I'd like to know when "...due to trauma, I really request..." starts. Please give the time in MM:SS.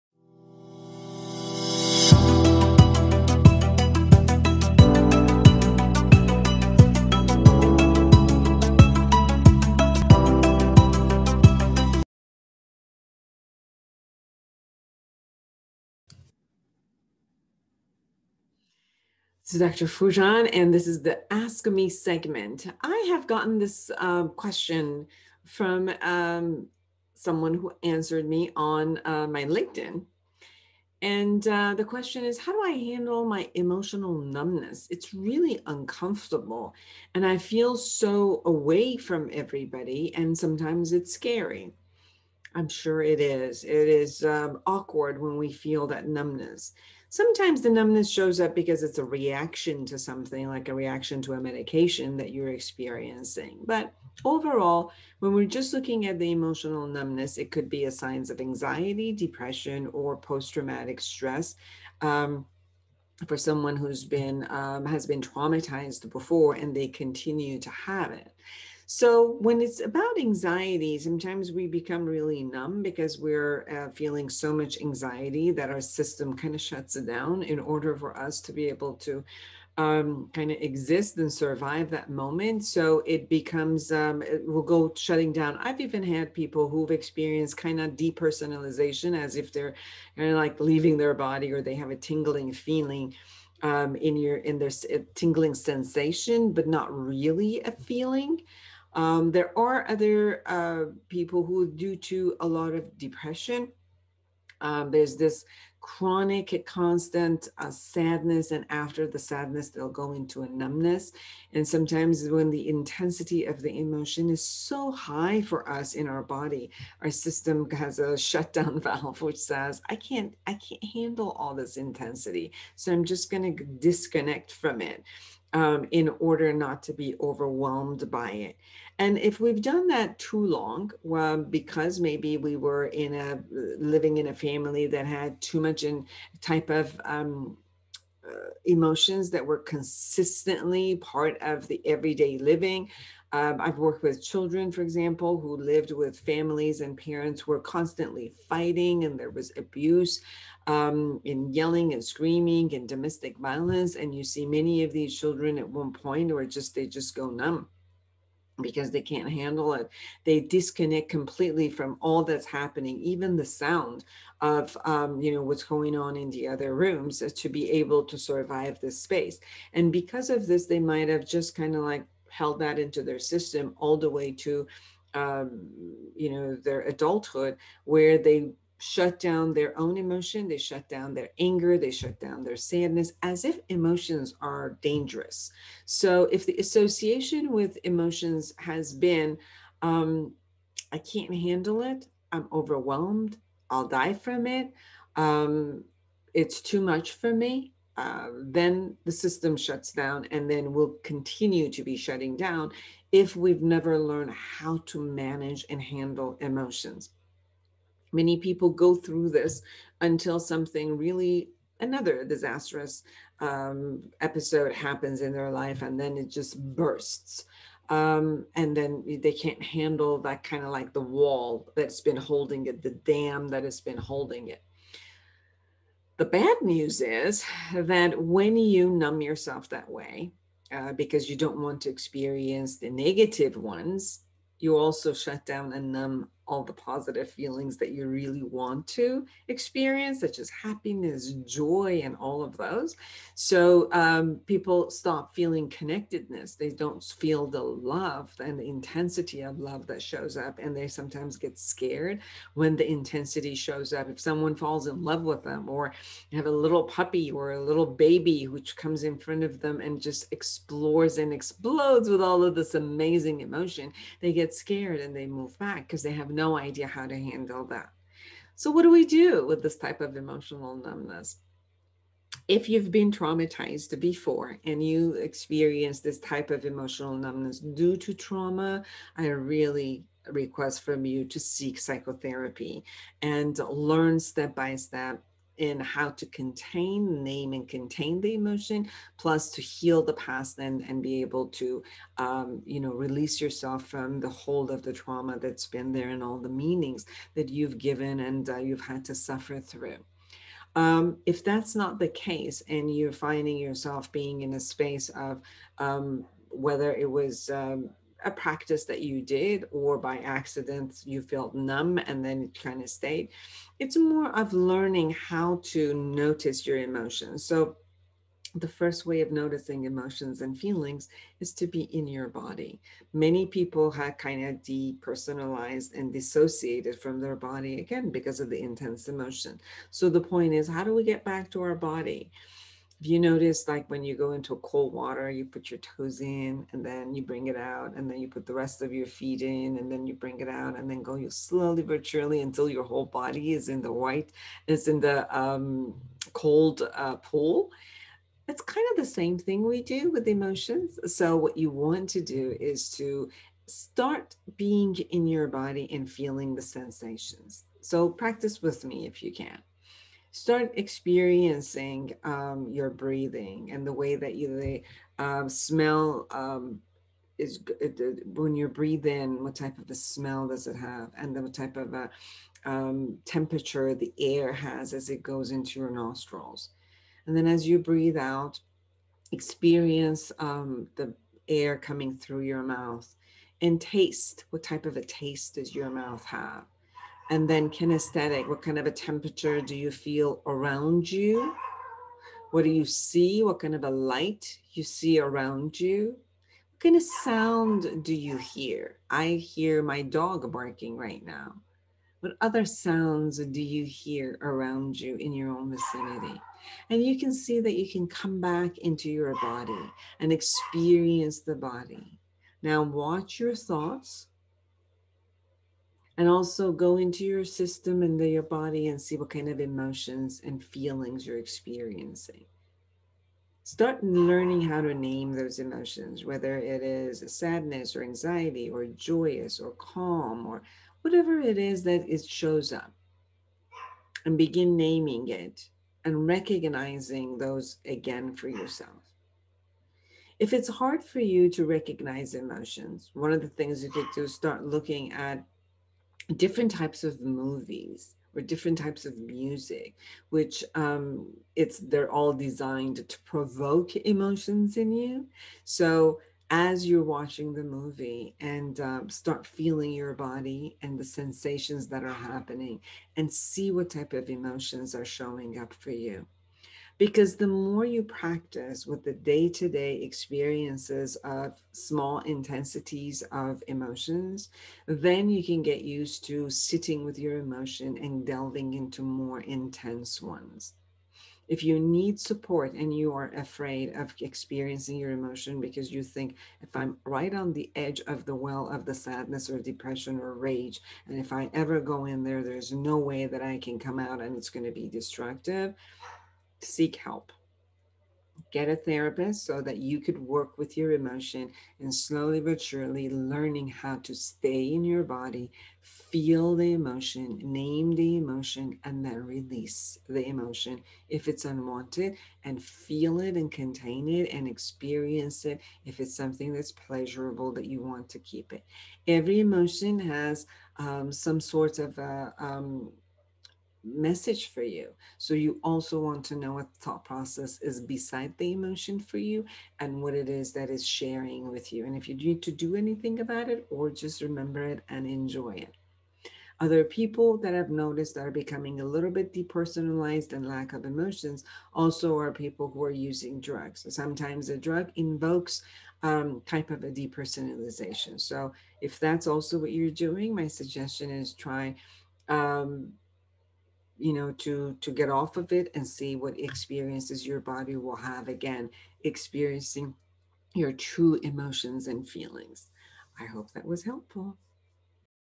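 04:37.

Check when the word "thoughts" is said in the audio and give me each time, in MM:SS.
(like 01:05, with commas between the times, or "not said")
06:53, 08:46.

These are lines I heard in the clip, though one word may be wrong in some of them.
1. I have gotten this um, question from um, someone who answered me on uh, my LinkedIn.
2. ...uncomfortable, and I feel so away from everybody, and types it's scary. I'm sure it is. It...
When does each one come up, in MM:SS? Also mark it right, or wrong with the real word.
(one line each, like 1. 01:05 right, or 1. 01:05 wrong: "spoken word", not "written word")
1. 00:22 right
2. 00:35 wrong: "sometimes", not "types".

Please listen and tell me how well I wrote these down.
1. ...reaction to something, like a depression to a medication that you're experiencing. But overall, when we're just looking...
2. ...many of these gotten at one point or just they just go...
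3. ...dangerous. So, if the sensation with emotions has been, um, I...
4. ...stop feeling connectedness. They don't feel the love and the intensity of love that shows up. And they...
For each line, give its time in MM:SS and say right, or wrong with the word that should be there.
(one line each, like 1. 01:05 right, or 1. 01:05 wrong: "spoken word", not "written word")
1. 00:49 wrong: "reaction", not "depression"
2. 02:34 wrong: "children", not "gotten"
3. 03:04 wrong: "association", not "sensation"
4. 04:04 right.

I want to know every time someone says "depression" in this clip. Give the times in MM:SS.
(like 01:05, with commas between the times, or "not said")
00:59, 01:42, 08:09.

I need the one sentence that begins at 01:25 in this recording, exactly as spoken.
I've even had people who've experienced kind of depersonalization as if they're like leaving their body or they have a tingling feeling.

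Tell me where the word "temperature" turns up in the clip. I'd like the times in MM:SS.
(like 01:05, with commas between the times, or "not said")
06:13, 06:28.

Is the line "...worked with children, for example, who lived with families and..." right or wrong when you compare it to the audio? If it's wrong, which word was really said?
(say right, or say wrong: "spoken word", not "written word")
right.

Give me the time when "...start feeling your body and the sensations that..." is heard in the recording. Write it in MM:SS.
07:39.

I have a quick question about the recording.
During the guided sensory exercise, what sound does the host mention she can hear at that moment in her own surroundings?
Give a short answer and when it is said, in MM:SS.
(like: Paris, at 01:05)
Dog barking, at 06:40.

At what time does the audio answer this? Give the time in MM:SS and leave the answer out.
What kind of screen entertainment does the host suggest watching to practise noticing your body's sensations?
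07:27.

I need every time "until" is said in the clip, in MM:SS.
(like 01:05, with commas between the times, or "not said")
03:30, 05:42.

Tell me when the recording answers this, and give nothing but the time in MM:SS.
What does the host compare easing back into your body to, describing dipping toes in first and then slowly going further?
05:34.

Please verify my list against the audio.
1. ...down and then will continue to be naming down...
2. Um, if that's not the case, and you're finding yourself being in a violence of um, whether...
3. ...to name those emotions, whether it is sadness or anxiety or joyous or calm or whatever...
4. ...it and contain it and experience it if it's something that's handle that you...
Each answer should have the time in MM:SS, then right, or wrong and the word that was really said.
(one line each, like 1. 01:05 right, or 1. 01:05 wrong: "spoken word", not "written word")
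1. 03:19 wrong: "shutting", not "naming"
2. 05:00 wrong: "space", not "violence"
3. 07:04 right
4. 08:33 wrong: "pleasurable", not "handle".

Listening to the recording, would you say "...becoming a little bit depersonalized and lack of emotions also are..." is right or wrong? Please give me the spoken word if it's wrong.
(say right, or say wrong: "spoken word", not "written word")
right.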